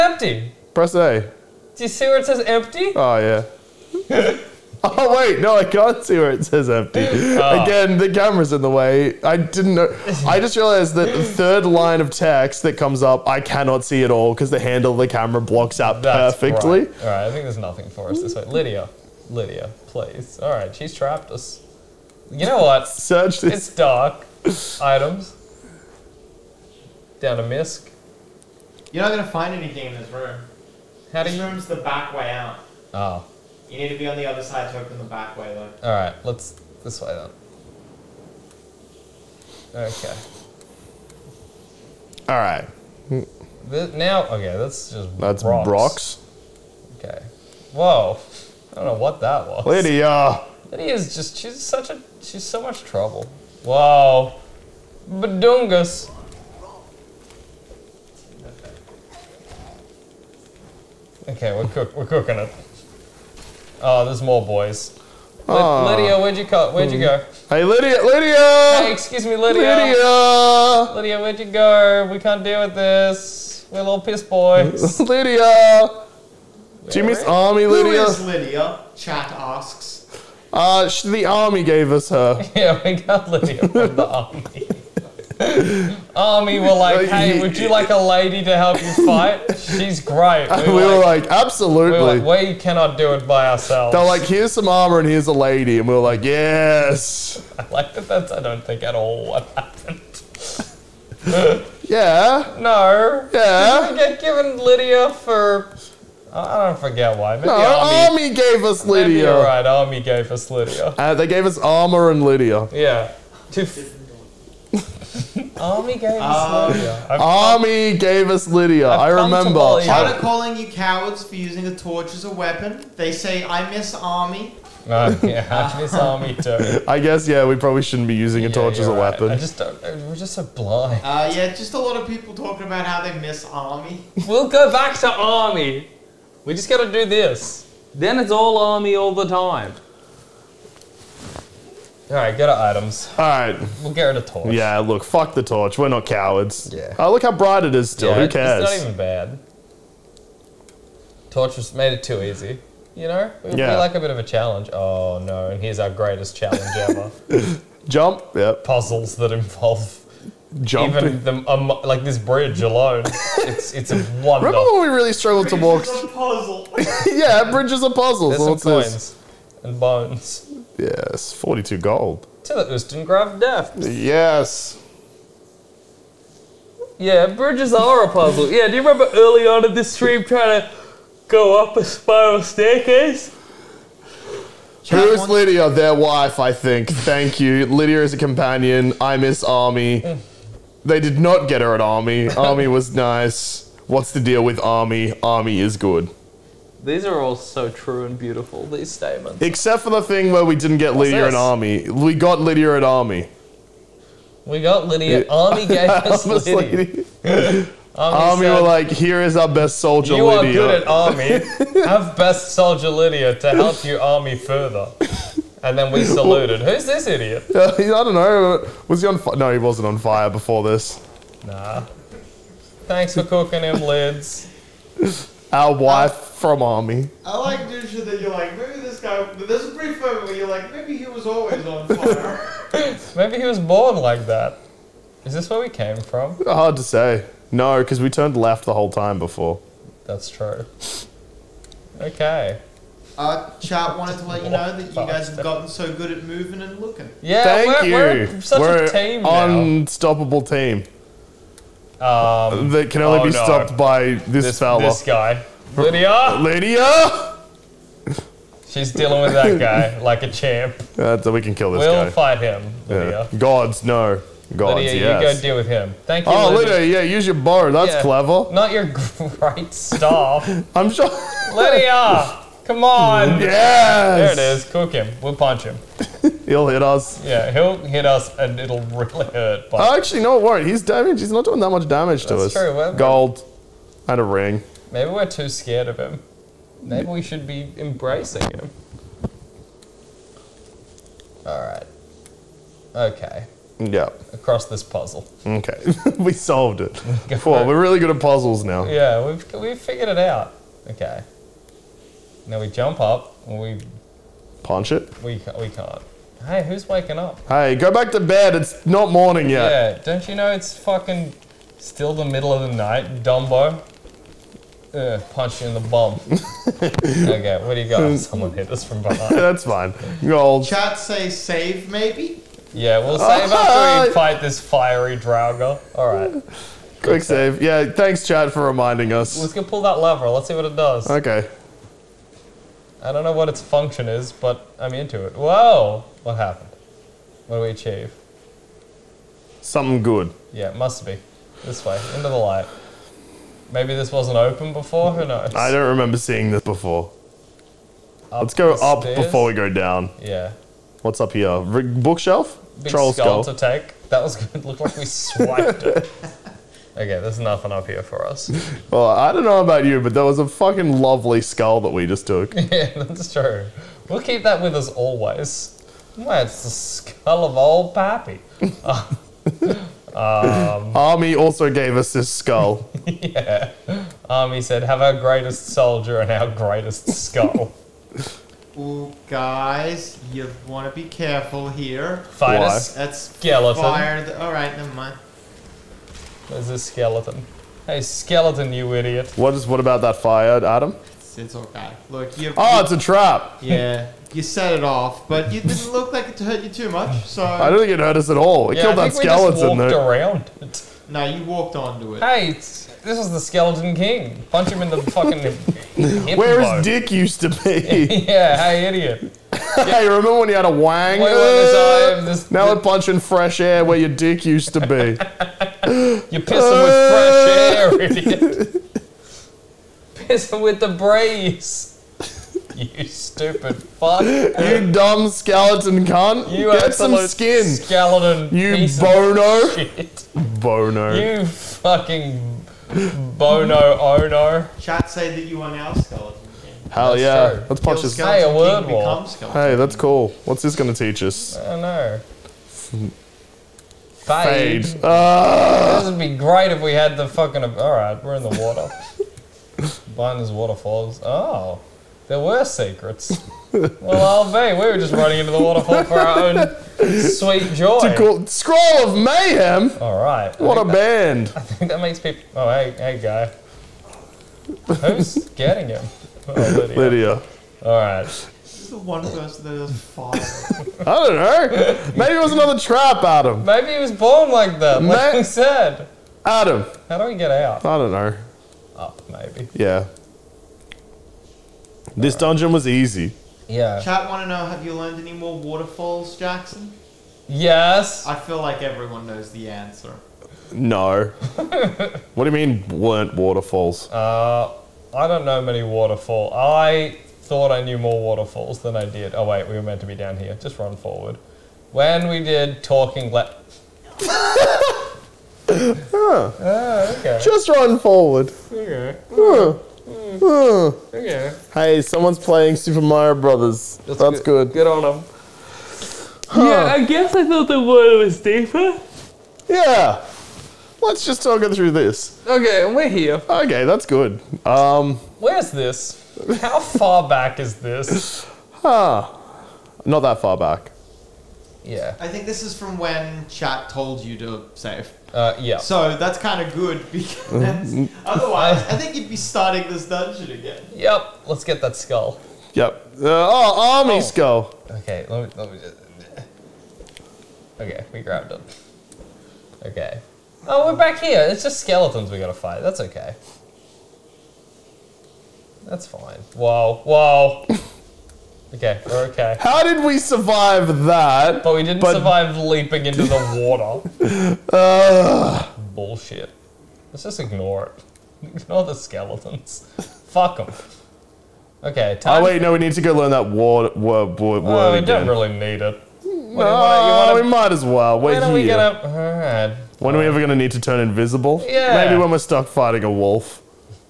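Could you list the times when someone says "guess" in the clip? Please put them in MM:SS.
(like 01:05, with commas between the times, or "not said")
02:06, 08:37.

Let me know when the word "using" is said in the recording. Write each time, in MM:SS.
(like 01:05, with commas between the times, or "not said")
02:01, 02:08.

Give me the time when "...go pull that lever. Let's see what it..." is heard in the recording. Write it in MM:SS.
05:29.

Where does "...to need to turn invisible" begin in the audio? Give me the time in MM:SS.
09:40.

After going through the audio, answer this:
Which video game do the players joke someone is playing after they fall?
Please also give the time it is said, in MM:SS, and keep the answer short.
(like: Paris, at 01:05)
Super Mario Brothers, at 08:32.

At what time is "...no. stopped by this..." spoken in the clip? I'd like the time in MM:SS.
04:13.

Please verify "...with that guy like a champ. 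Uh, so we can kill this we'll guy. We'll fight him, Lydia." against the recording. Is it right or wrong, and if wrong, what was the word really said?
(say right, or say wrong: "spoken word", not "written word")
right.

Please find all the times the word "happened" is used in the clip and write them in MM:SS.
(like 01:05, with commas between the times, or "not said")
01:39, 05:36.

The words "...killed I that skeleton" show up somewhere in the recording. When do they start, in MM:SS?
06:38.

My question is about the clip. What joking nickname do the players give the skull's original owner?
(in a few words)
Old Pappy.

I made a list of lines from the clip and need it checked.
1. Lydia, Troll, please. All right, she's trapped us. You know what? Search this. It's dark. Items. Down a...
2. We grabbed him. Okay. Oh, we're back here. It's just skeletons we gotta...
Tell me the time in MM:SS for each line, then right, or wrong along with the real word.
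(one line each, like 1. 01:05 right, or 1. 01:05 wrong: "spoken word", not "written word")
1. 00:18 wrong: "Lydia", not "Troll"
2. 09:08 right.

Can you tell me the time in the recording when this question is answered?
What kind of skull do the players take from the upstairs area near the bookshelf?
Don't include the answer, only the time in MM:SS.
05:52.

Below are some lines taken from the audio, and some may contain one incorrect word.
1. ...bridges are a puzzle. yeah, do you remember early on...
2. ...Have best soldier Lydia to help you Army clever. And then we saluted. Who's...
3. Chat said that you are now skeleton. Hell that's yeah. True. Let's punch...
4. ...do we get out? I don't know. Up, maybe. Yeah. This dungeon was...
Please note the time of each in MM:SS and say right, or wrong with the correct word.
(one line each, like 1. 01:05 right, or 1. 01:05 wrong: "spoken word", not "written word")
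1. 02:57 right
2. 03:31 wrong: "further", not "clever"
3. 07:14 right
4. 07:57 right.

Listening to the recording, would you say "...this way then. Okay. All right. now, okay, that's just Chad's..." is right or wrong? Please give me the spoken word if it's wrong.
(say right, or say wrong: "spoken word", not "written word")
wrong: "That", not "Chad".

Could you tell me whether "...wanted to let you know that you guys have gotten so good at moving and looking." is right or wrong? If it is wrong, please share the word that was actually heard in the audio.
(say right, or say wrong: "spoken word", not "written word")
right.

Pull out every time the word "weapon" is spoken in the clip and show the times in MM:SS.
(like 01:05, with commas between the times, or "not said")
02:02, 02:08.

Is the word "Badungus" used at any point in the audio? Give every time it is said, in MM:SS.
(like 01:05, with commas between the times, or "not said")
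00:55.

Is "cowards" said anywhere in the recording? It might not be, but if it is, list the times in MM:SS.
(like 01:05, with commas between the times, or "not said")
02:00, 02:26.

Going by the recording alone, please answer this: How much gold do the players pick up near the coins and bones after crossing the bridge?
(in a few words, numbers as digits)
42.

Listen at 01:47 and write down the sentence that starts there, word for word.
Maybe no, Army, Army gave us Lydia.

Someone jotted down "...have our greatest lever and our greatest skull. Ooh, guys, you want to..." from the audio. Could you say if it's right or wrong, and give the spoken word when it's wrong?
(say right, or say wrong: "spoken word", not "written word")
wrong: "soldier", not "lever".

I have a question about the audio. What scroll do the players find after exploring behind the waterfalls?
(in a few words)
Scroll of Mayhem.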